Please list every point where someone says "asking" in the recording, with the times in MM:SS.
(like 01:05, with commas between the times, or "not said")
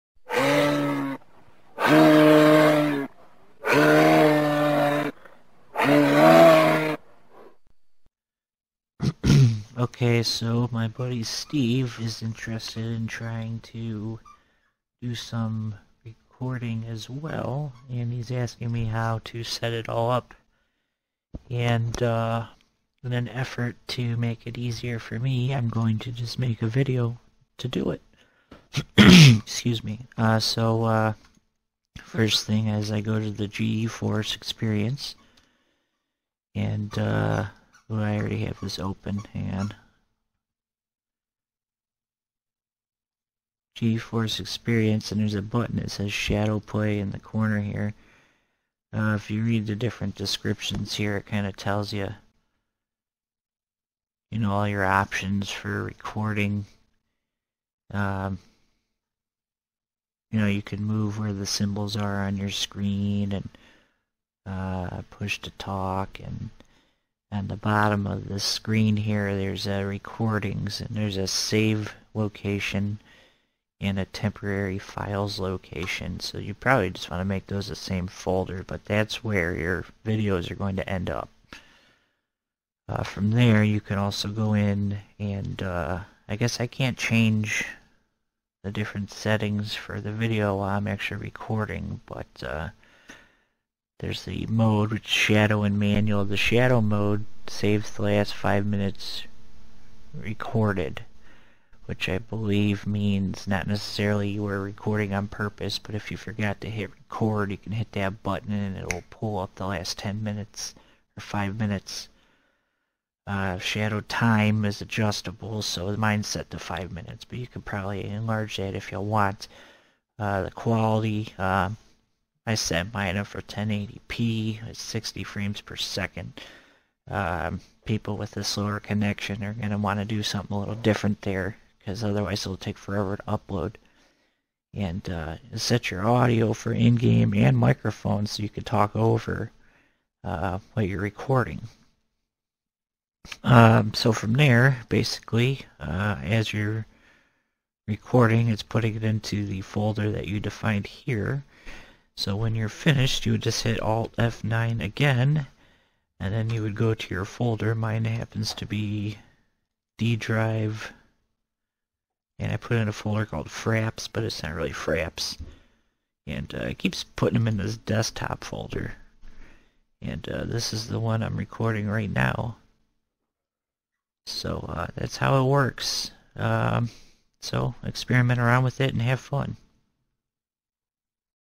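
00:18.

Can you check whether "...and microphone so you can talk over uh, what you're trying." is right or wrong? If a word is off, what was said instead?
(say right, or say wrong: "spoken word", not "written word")
wrong: "recording", not "trying".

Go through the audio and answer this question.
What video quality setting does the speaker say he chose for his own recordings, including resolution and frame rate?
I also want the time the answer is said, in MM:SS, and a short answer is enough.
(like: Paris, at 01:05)
1080p at 60 frames per second, at 02:03.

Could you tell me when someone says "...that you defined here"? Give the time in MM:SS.
02:30.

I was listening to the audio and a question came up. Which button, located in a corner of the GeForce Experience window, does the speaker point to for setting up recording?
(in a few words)
Shadow Play.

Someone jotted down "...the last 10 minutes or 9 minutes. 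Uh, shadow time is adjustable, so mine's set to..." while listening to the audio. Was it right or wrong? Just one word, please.
wrong.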